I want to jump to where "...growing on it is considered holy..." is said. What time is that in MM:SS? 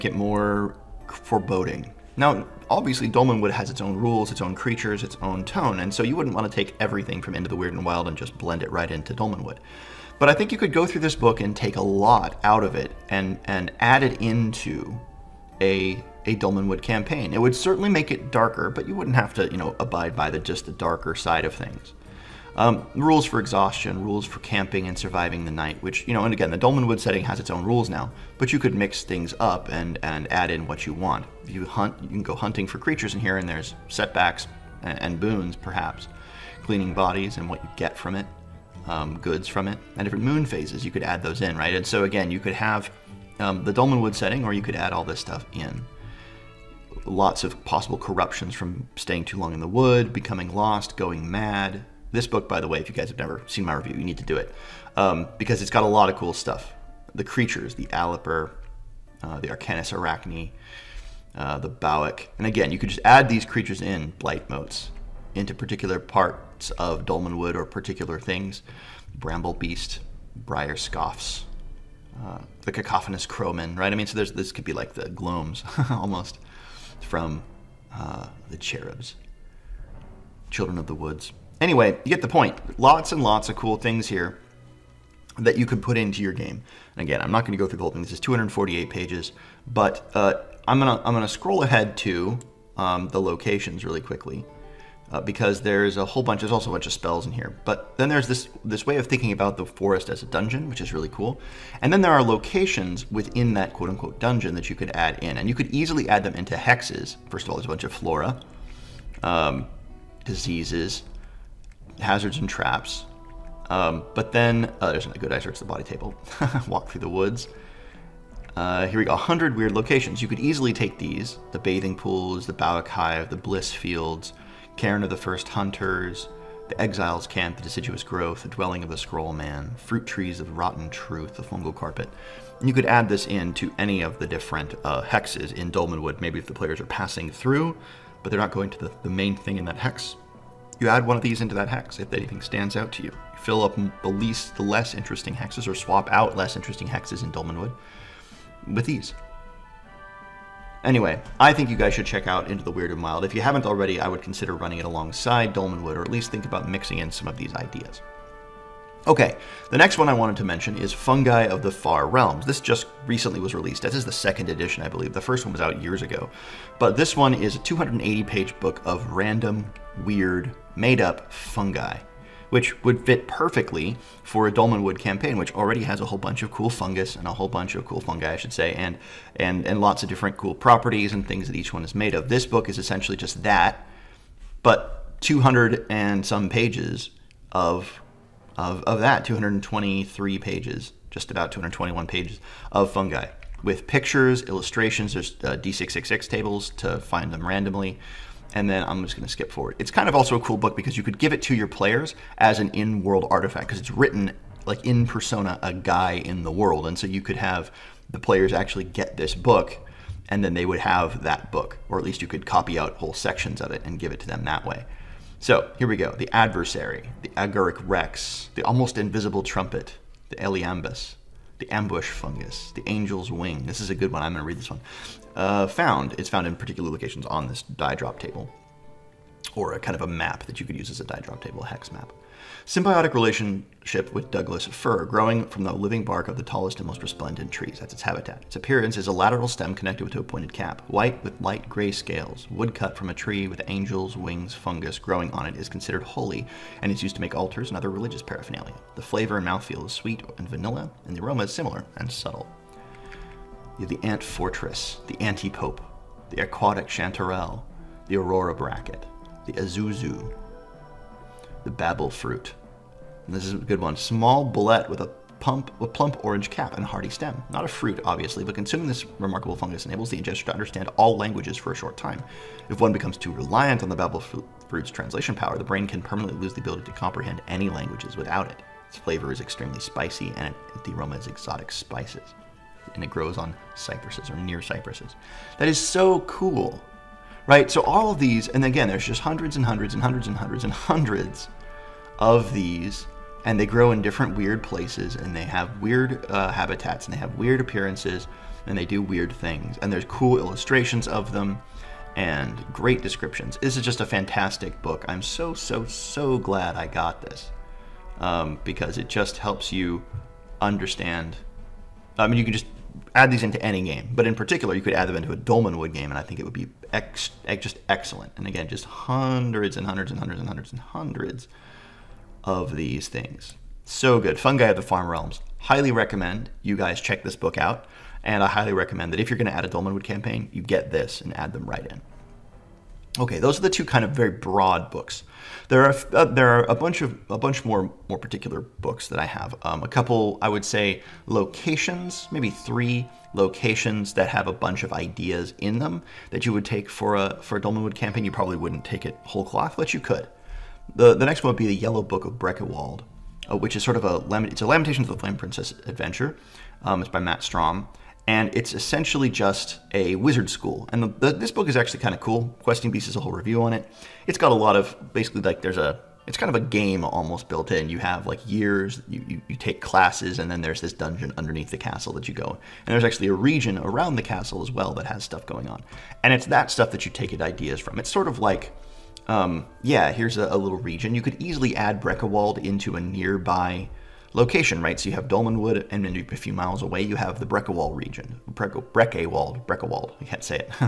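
04:04.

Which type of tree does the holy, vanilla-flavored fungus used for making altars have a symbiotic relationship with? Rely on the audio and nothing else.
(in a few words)
Douglas fir.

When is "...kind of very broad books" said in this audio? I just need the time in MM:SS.
05:33.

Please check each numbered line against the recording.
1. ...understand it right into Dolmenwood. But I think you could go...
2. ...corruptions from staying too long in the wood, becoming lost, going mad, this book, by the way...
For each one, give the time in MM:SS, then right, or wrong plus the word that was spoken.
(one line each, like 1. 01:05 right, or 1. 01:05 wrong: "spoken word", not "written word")
1. 00:08 wrong: "blend", not "understand"
2. 00:47 right.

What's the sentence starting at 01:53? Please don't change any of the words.
Um, but then, oh, there's a good eye search the body table.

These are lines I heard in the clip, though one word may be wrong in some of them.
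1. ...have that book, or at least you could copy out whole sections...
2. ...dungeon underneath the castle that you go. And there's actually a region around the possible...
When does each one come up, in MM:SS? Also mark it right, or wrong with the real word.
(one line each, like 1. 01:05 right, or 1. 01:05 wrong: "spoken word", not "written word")
1. 03:30 right
2. 06:10 wrong: "castle", not "possible".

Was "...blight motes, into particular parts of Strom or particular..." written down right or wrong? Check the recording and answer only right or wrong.
wrong.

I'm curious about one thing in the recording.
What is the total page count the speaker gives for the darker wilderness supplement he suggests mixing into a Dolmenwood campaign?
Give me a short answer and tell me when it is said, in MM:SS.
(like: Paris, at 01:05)
248, at 01:28.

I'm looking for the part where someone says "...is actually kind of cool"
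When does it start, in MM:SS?
06:01.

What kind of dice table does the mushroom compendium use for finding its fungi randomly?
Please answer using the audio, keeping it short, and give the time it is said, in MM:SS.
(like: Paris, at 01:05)
D666, at 03:15.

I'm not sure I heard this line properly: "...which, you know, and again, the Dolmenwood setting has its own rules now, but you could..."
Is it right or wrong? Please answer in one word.
right.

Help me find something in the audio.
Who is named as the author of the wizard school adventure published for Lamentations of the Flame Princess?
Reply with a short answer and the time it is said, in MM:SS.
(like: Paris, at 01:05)
Matt Strom, at 05:57.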